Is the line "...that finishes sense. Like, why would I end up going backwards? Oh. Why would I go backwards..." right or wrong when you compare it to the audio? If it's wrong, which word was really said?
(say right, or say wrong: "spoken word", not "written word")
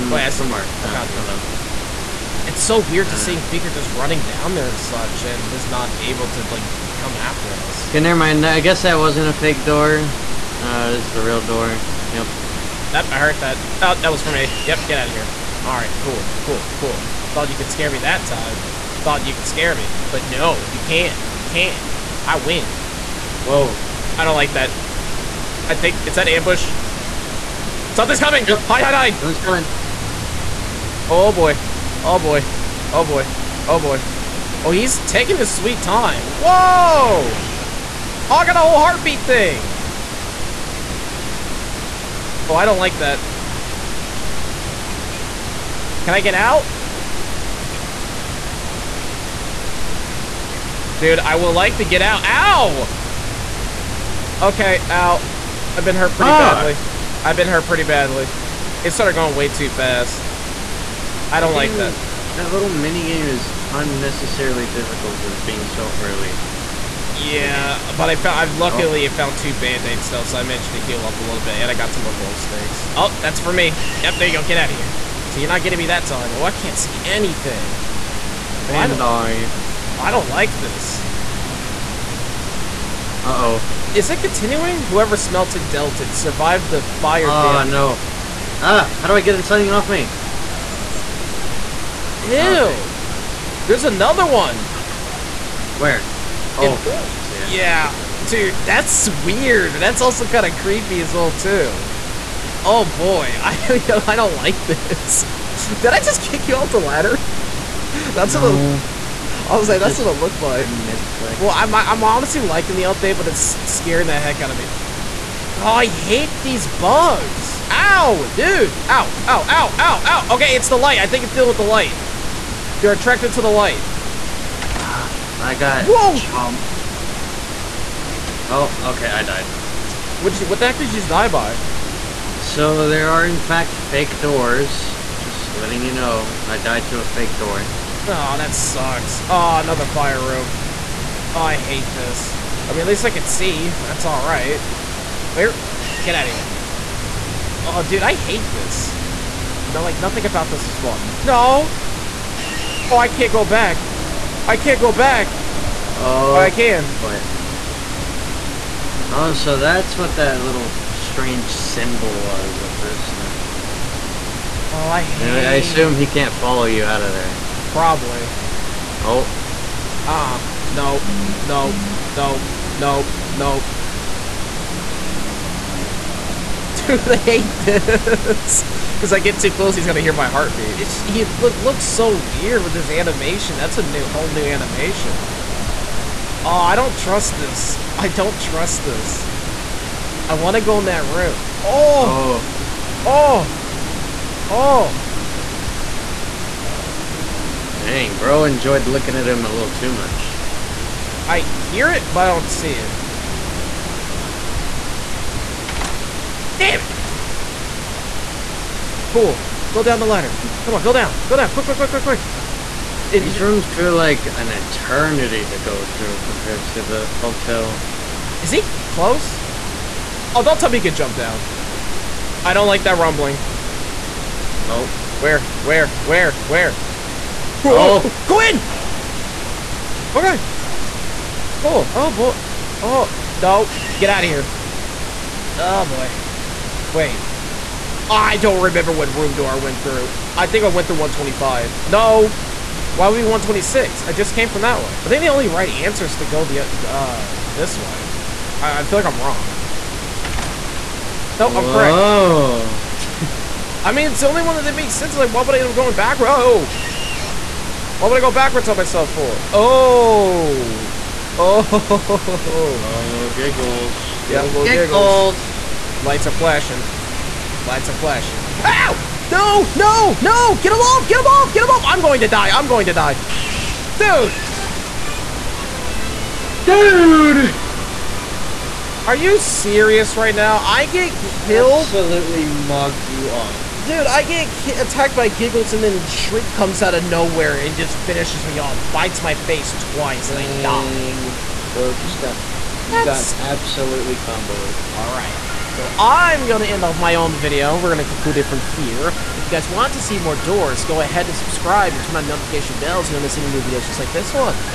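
wrong: "makes", not "finishes".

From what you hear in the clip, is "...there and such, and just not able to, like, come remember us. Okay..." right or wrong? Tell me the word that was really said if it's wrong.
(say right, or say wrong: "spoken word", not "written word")
wrong: "after", not "remember".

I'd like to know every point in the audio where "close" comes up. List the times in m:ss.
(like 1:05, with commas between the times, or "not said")
2:59, 3:38.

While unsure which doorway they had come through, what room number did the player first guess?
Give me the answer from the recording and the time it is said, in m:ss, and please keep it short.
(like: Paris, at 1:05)
125, at 4:00.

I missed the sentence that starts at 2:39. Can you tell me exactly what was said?
Oh, so that's what that little strange symbol was the first time.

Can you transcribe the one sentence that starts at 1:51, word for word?
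Well, I'm, I'm honestly liking the update, but it's scaring the heck out of me.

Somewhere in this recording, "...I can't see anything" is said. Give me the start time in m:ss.
1:16.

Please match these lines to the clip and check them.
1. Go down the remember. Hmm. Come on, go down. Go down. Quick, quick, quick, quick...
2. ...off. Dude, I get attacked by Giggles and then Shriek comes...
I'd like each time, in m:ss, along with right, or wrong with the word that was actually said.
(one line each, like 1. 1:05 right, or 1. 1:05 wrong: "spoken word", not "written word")
1. 3:29 wrong: "ladder", not "remember"
2. 4:43 right.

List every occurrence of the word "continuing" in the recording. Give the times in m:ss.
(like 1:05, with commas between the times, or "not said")
1:24.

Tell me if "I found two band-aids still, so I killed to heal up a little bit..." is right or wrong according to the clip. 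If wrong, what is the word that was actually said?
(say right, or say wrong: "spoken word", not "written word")
wrong: "managed", not "killed".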